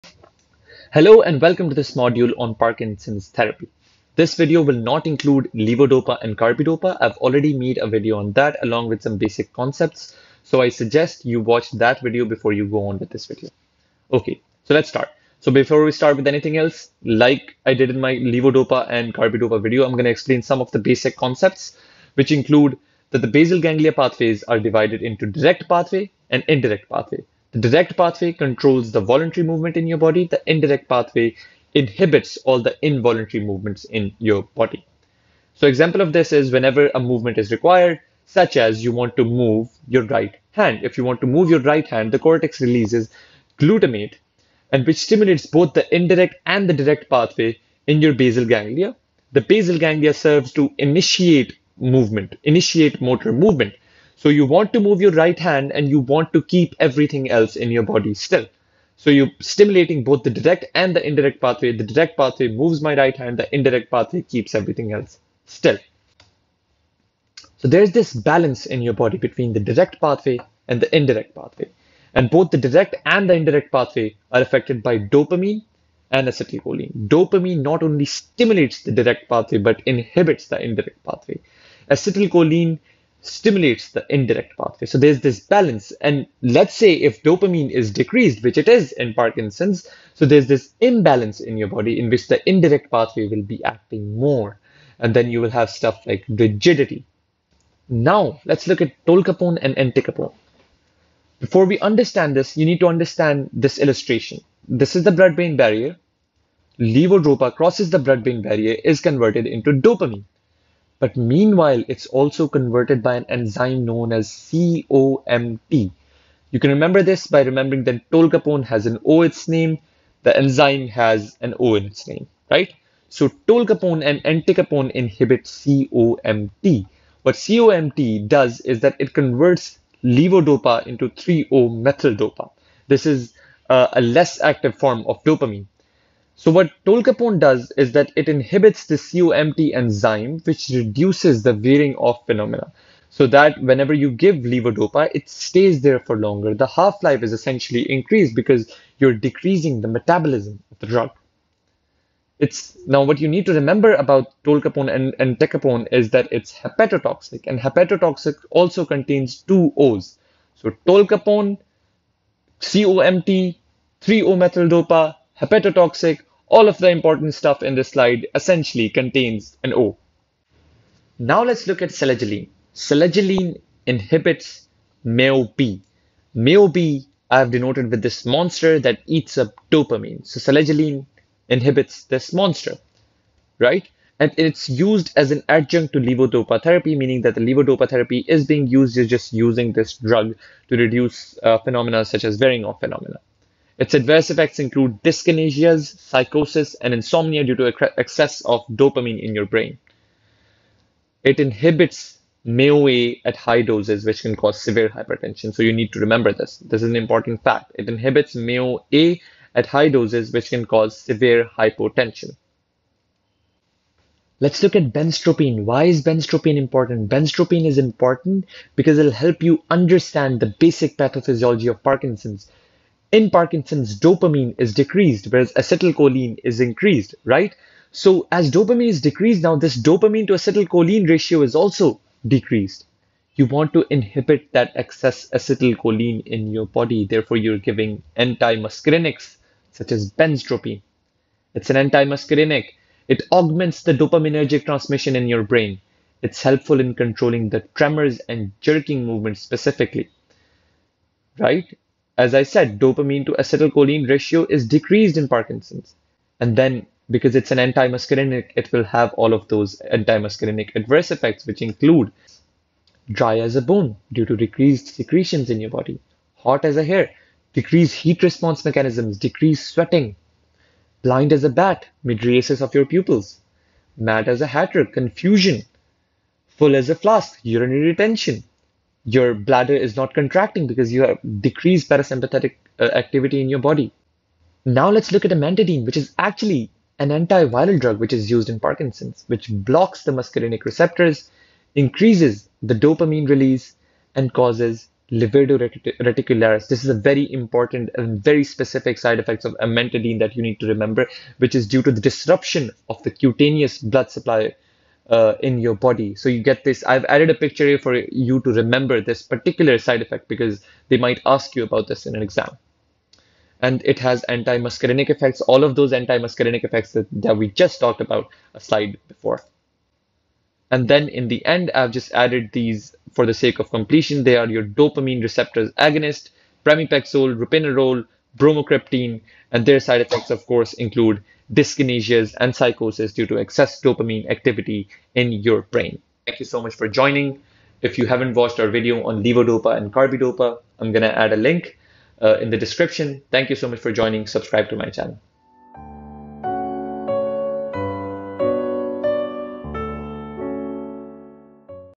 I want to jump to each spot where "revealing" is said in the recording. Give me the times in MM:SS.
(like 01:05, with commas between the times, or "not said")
not said.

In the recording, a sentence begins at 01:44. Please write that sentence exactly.
This is the blood brain barrier.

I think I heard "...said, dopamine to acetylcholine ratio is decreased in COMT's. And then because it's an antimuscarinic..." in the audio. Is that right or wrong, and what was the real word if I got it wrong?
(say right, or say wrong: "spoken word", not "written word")
wrong: "Parkinson", not "COMT".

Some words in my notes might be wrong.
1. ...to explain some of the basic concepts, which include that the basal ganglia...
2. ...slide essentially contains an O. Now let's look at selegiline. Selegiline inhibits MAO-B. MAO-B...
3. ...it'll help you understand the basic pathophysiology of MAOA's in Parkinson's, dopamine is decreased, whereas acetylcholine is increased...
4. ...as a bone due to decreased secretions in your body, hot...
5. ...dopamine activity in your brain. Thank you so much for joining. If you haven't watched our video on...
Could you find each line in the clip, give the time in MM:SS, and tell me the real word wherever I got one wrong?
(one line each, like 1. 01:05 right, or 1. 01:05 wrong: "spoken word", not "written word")
1. 00:20 right
2. 02:47 right
3. 03:38 wrong: "Parkinson", not "MAOA"
4. 04:23 right
5. 05:33 right.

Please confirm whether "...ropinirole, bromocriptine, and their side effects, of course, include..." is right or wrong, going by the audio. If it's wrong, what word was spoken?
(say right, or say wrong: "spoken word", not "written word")
right.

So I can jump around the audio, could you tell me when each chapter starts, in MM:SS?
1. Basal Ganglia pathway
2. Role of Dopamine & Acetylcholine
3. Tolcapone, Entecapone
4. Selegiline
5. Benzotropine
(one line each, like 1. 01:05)
1. 00:15
2. 01:15
3. 01:37
4. 02:49
5. 03:33.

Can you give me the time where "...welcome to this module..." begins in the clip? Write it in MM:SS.
00:01.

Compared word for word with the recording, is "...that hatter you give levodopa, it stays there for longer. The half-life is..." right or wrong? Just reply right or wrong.
wrong.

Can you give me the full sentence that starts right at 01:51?
But meanwhile, it's also converted by an enzyme known as COMT.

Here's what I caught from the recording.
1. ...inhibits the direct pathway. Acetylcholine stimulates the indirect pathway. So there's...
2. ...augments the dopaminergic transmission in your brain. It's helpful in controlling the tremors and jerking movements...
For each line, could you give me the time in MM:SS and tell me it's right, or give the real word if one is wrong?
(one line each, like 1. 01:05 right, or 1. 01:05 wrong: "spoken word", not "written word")
1. 01:19 wrong: "indirect", not "direct"
2. 04:03 right.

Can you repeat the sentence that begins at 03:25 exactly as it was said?
So you need to remember this.